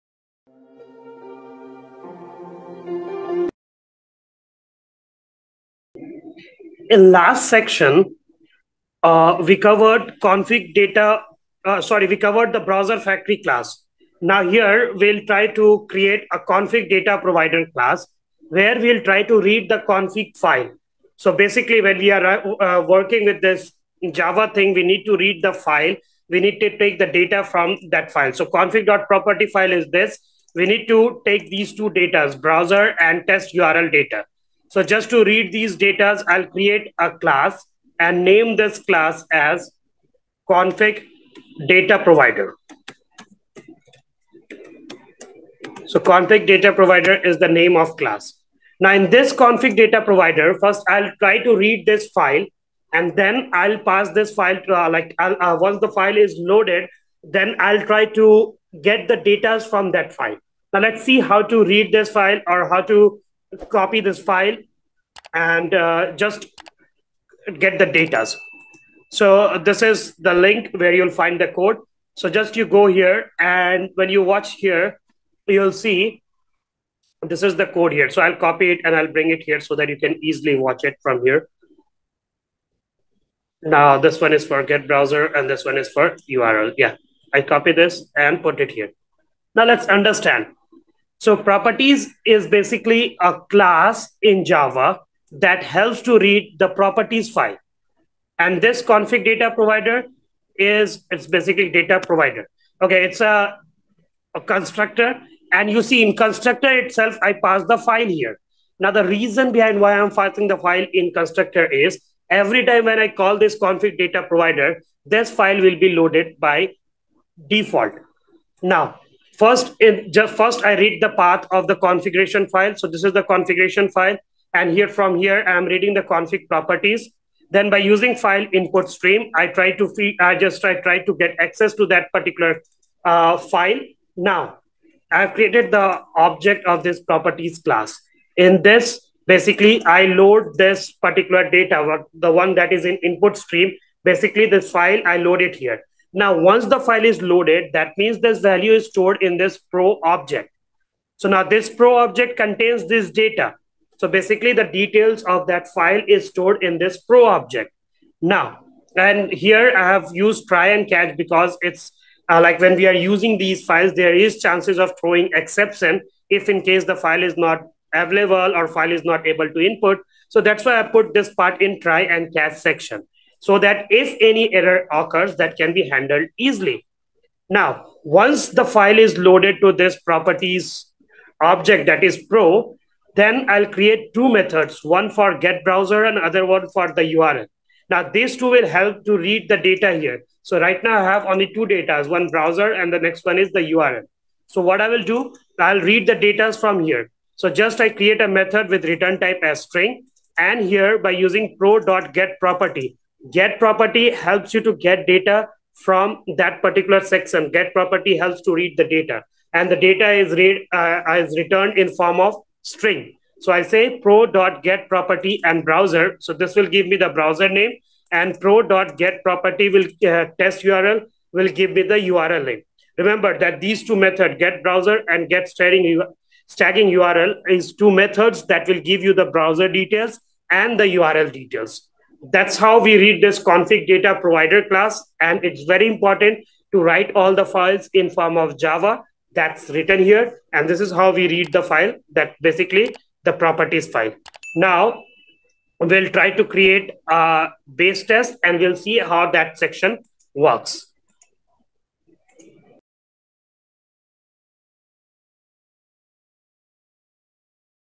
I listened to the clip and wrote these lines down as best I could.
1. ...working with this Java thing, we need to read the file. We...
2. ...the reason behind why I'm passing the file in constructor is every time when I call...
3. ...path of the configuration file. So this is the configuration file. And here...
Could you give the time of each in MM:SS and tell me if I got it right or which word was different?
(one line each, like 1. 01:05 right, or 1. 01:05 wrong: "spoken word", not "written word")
1. 00:22 right
2. 01:48 right
3. 02:01 right.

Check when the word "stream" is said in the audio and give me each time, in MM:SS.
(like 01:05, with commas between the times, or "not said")
02:08, 02:23.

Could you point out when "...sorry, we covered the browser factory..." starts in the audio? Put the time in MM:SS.
00:11.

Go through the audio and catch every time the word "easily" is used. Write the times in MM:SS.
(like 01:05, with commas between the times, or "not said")
01:20, 02:56.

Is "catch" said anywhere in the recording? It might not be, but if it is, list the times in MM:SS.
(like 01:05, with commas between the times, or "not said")
02:40, 02:52.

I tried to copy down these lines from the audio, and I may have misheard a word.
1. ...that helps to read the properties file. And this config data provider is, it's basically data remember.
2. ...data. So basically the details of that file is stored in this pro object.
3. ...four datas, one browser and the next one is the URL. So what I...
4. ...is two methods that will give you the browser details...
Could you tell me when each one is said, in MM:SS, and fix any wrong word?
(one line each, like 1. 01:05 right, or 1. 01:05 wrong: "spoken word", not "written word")
1. 01:35 wrong: "provider", not "remember"
2. 02:33 right
3. 03:11 wrong: "two", not "four"
4. 03:47 right.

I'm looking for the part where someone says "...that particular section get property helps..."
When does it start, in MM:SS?
03:26.